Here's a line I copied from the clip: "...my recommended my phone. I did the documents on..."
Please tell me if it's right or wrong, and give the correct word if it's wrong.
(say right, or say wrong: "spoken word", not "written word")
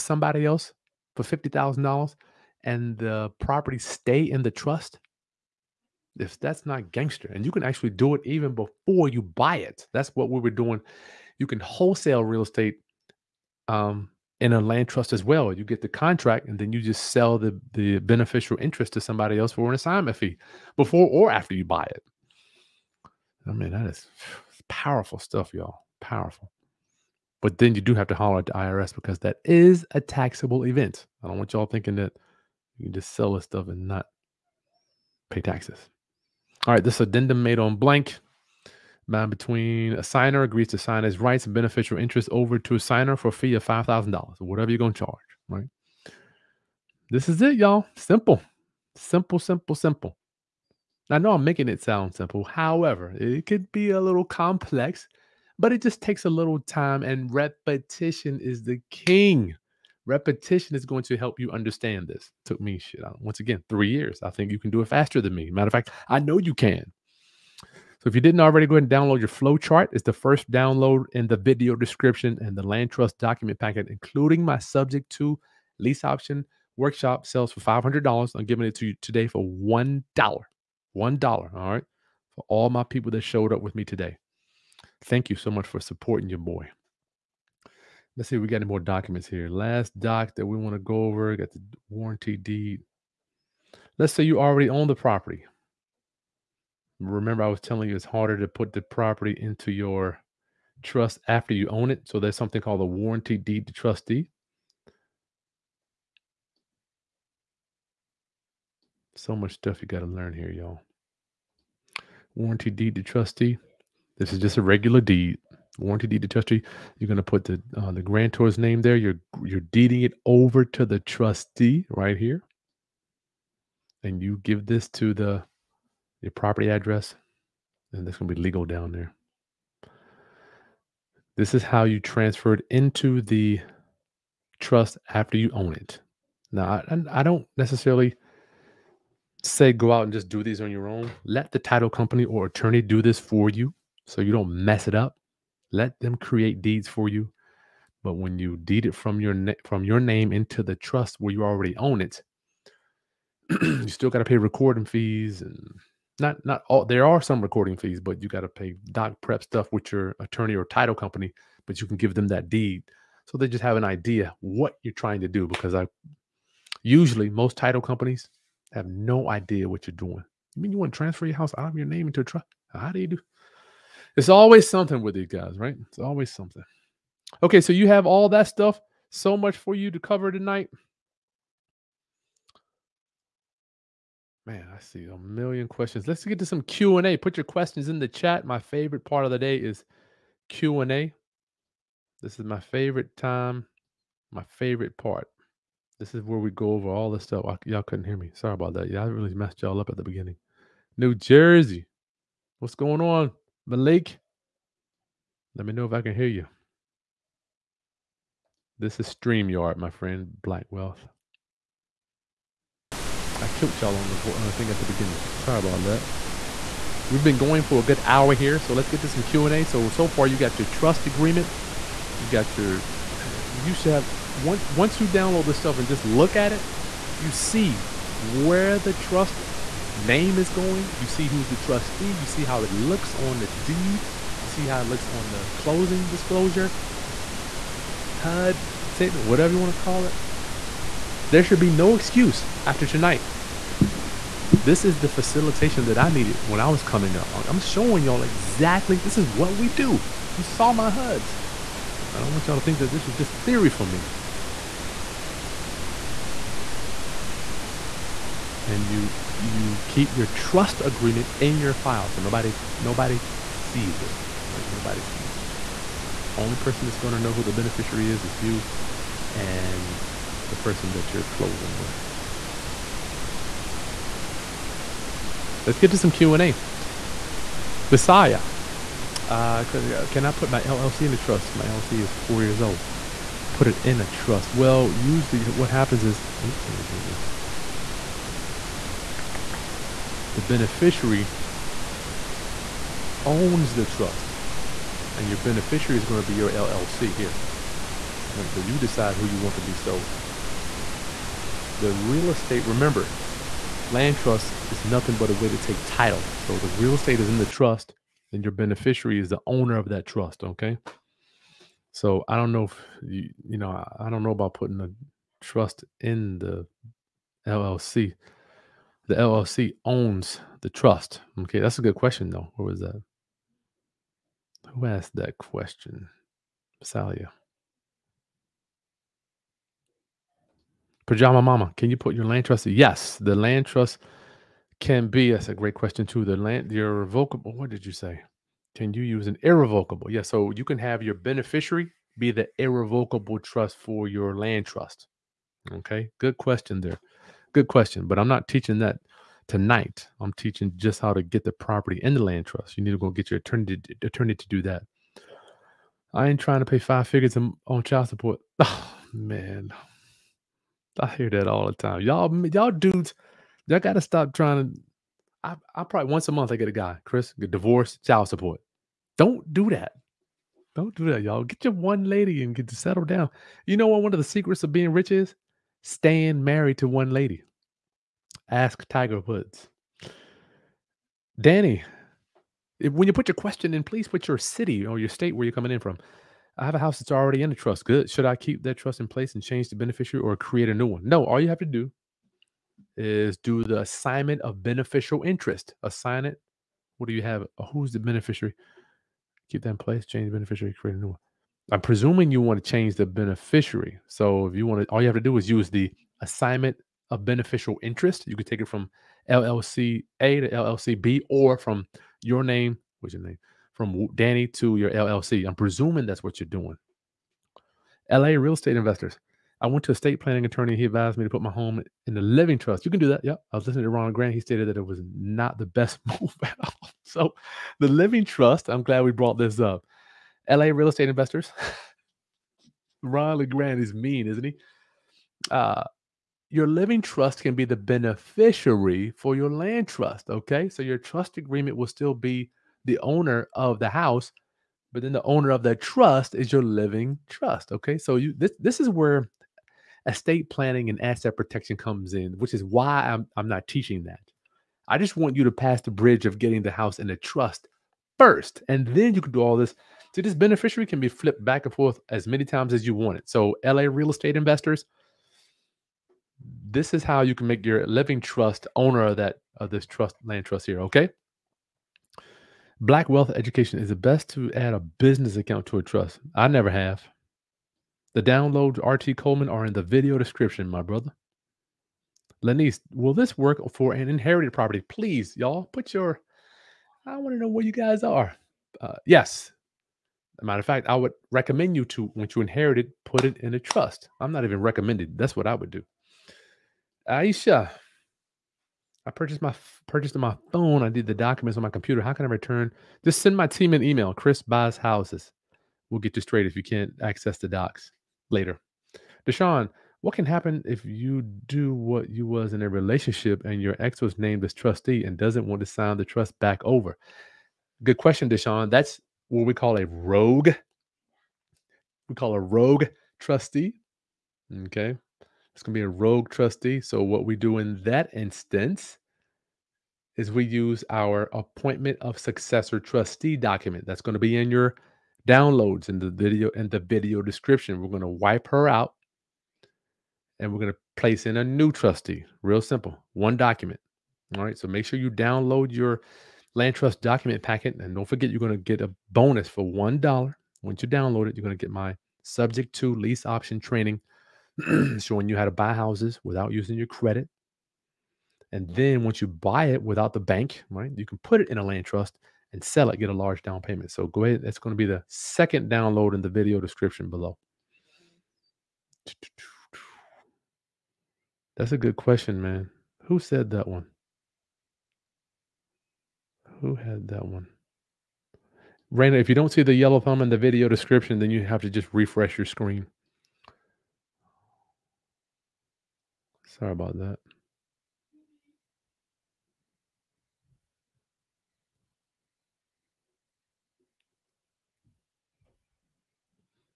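wrong: "purchased", not "recommended".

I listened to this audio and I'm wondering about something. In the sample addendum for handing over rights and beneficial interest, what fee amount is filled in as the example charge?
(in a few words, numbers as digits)
$5,000.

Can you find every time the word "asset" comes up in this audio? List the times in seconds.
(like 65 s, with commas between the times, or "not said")
451 s.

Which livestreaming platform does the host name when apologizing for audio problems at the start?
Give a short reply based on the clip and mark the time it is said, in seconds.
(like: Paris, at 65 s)
StreamYard, at 209 s.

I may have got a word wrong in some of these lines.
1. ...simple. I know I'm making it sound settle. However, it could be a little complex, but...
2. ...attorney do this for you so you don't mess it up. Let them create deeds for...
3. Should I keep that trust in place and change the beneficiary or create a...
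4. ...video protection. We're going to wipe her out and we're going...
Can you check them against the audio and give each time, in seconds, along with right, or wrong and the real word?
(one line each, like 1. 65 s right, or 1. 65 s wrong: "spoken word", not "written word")
1. 49 s wrong: "simple", not "settle"
2. 142 s right
3. 388 s right
4. 536 s wrong: "description", not "protection".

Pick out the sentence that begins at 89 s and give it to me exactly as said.
Last doc that we want to go over, got the warranty deed.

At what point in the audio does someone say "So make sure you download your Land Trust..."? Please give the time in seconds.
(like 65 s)
544 s.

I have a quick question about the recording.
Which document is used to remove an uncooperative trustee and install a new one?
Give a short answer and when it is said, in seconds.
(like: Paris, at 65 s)
Appointment of successor trustee, at 531 s.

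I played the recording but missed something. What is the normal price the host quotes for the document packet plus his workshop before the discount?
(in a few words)
$500.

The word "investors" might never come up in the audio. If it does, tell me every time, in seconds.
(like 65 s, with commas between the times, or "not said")
418 s, 431 s, 464 s.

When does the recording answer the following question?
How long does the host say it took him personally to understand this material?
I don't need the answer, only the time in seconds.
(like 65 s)
63 s.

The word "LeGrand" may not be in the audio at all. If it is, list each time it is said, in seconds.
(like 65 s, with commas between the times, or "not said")
424 s, 433 s.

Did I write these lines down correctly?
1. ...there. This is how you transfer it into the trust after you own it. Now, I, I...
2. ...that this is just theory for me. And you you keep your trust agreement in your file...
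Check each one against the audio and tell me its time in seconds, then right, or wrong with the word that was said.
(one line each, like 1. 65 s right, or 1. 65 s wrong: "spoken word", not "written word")
1. 128 s right
2. 252 s right.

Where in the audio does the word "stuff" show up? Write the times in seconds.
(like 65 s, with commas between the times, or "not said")
25 s, 33 s, 109 s, 159 s, 178 s, 197 s, 225 s.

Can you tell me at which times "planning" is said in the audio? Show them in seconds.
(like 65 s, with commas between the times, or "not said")
420 s, 450 s.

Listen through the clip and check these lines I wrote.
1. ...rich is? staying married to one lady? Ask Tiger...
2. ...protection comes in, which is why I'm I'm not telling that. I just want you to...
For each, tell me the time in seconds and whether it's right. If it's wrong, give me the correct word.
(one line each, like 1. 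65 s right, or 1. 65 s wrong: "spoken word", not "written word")
1. 374 s right
2. 451 s wrong: "teaching", not "telling".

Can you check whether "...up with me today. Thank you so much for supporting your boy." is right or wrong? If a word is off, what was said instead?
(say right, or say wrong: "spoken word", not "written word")
right.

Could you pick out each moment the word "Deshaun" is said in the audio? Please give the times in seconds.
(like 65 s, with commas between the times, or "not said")
509 s, 518 s.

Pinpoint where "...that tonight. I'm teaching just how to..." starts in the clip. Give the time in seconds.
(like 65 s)
348 s.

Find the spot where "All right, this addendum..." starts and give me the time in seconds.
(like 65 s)
36 s.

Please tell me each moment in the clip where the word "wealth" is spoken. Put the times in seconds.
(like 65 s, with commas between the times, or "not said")
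210 s, 473 s.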